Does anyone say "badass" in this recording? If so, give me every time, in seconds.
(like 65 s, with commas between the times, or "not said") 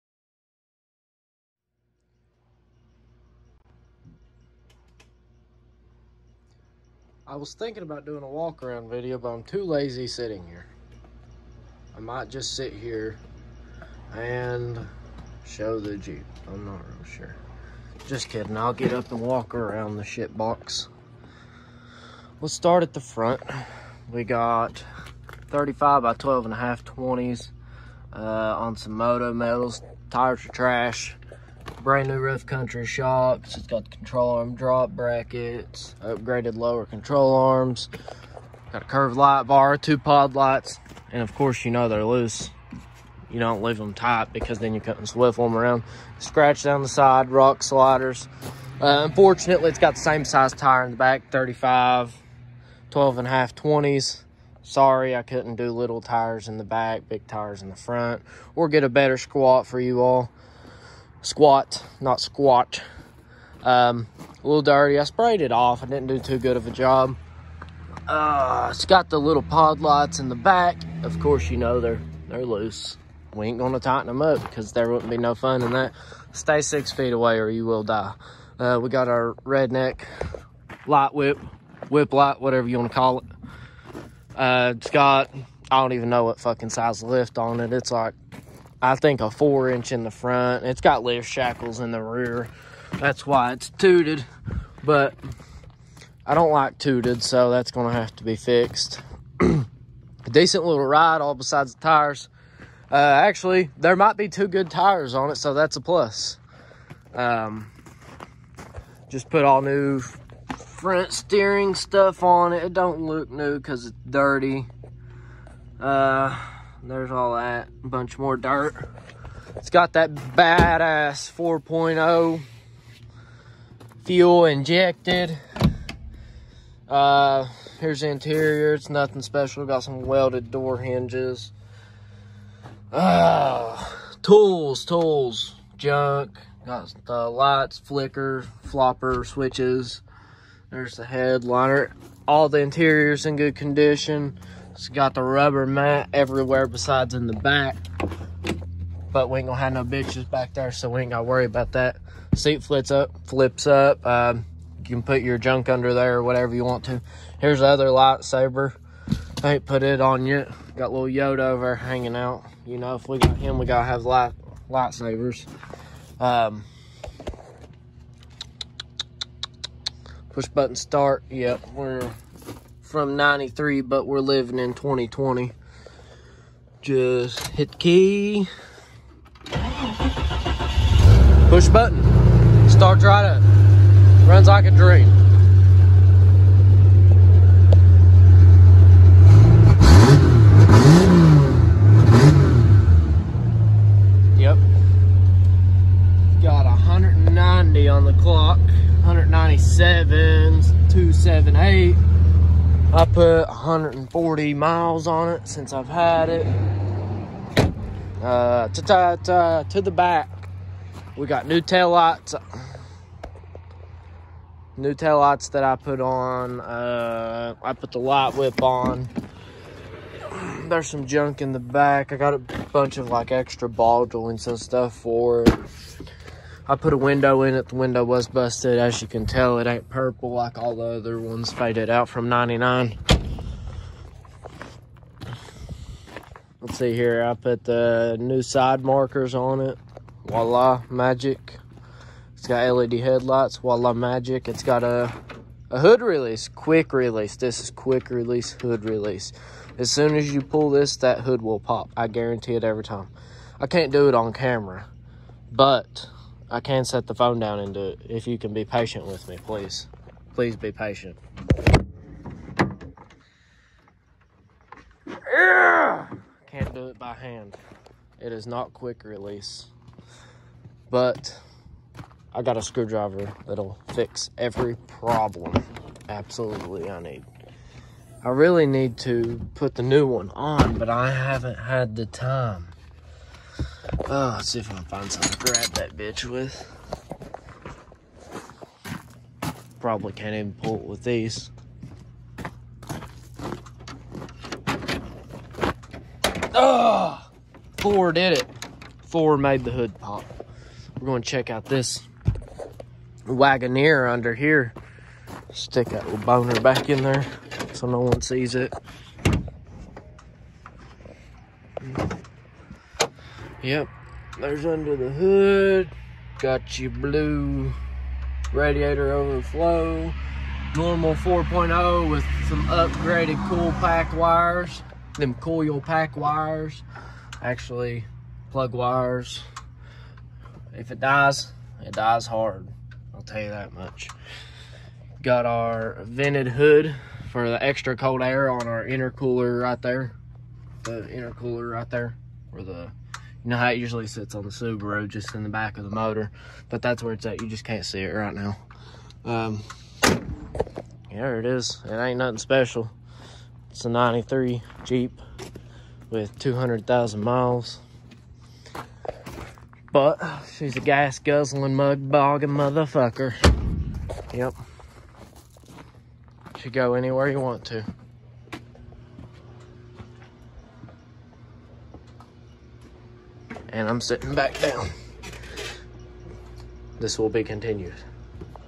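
120 s.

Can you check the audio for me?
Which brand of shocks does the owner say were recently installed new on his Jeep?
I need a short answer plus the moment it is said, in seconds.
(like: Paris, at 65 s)
Rough Country, at 32 s.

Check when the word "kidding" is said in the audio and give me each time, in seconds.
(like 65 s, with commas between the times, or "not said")
18 s.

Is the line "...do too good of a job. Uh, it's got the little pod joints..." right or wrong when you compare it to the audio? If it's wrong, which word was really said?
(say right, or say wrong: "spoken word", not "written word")
wrong: "lights", not "joints".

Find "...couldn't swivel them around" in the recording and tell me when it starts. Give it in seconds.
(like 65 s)
44 s.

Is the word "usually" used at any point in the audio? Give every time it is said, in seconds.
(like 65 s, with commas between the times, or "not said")
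343 s.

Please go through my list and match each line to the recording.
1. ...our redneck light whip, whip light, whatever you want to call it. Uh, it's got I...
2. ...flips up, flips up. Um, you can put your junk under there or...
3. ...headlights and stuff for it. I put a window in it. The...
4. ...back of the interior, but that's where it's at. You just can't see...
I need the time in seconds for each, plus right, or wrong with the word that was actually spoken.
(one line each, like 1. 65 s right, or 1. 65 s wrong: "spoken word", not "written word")
1. 79 s right
2. 152 s right
3. 224 s wrong: "joints", not "headlights"
4. 345 s wrong: "motor", not "interior".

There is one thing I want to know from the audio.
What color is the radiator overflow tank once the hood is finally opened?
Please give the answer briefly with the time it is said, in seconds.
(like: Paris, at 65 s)
blue, at 316 s.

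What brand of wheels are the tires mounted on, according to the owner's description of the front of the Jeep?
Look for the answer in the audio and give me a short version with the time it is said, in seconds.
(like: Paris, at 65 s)
Moto Metals, at 28 s.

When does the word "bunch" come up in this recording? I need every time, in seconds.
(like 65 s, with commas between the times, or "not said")
117 s, 222 s.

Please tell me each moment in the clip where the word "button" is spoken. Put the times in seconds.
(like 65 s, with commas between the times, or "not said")
170 s, 181 s.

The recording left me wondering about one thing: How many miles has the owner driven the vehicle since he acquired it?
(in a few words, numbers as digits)
140.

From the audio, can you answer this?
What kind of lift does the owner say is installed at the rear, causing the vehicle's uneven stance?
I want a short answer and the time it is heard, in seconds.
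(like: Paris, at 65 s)
lift shackles, at 91 s.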